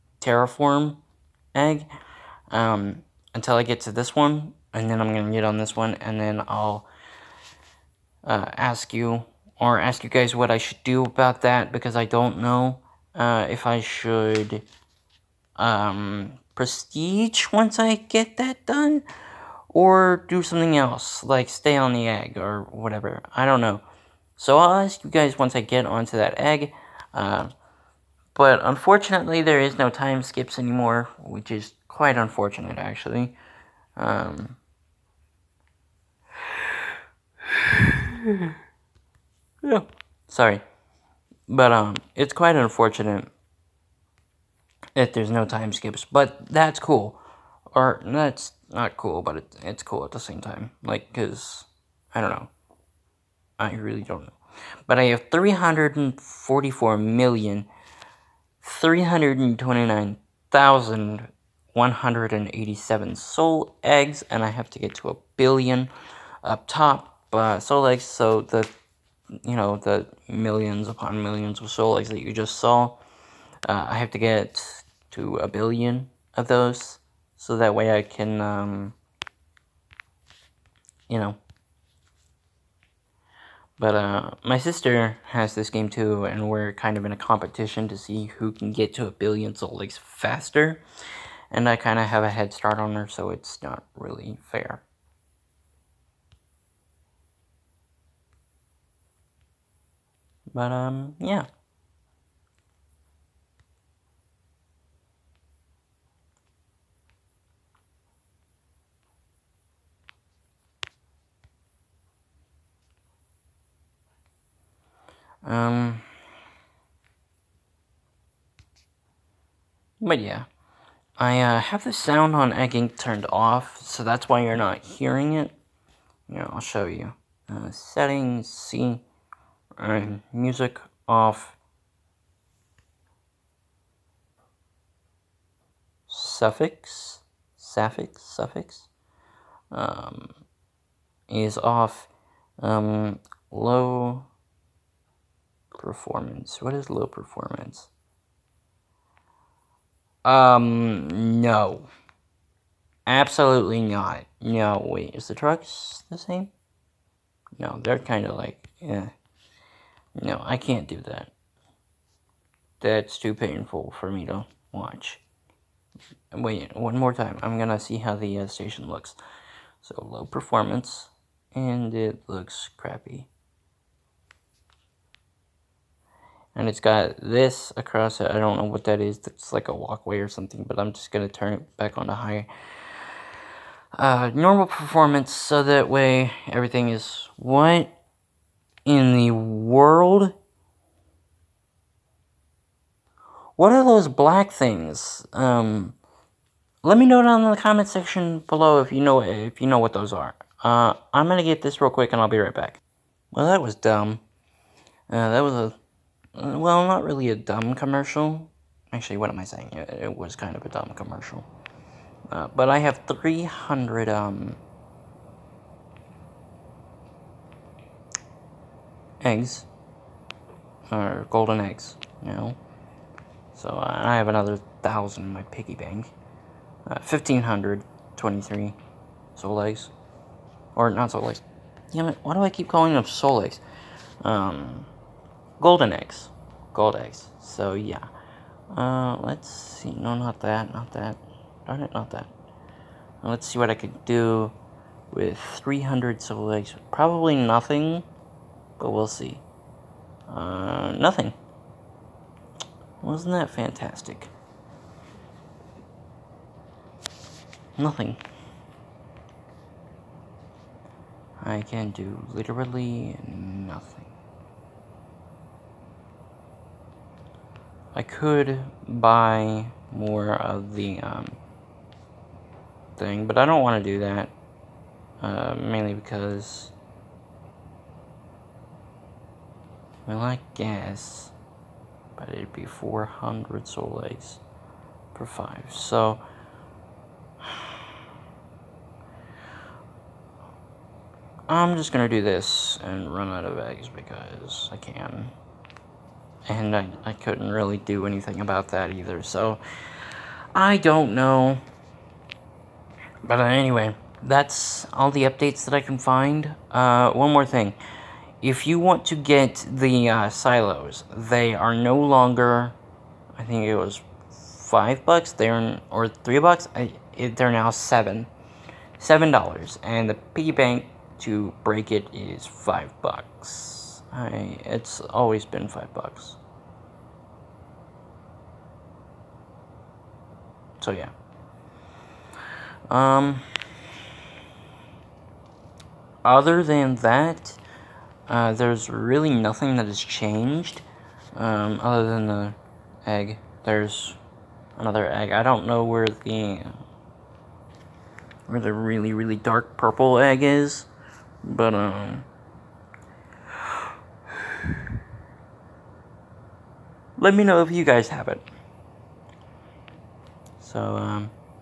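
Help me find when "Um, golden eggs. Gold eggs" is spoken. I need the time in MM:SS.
03:54.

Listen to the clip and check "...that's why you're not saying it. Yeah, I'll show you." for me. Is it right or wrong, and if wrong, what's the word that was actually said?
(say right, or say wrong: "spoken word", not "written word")
wrong: "hearing", not "saying".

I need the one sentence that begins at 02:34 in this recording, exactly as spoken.
No, wait, is the trucks the same?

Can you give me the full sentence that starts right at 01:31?
And I kind of have a head start on her, so it's not really fair.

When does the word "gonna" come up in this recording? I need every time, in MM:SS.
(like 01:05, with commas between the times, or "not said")
00:05, 02:47, 03:21, 04:51.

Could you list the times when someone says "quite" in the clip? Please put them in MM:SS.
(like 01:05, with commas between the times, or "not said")
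00:31, 00:42.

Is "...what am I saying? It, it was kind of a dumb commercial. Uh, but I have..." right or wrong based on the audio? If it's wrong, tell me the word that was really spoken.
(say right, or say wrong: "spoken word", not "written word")
right.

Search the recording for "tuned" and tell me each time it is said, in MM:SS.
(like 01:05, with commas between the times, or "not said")
not said.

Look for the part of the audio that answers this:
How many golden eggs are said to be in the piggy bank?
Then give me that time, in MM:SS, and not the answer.
03:44.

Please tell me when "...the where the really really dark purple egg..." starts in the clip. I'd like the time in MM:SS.
05:46.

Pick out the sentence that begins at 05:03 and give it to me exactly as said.
But anyway, that's all the updates that I can find.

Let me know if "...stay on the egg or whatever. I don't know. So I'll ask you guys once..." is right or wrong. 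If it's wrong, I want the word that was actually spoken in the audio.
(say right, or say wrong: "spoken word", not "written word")
right.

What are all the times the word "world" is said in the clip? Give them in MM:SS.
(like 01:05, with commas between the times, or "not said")
03:09.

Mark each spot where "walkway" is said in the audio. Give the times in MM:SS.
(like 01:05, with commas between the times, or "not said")
02:59.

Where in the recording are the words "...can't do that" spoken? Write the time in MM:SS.
02:40.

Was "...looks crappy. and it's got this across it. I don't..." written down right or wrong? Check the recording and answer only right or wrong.
right.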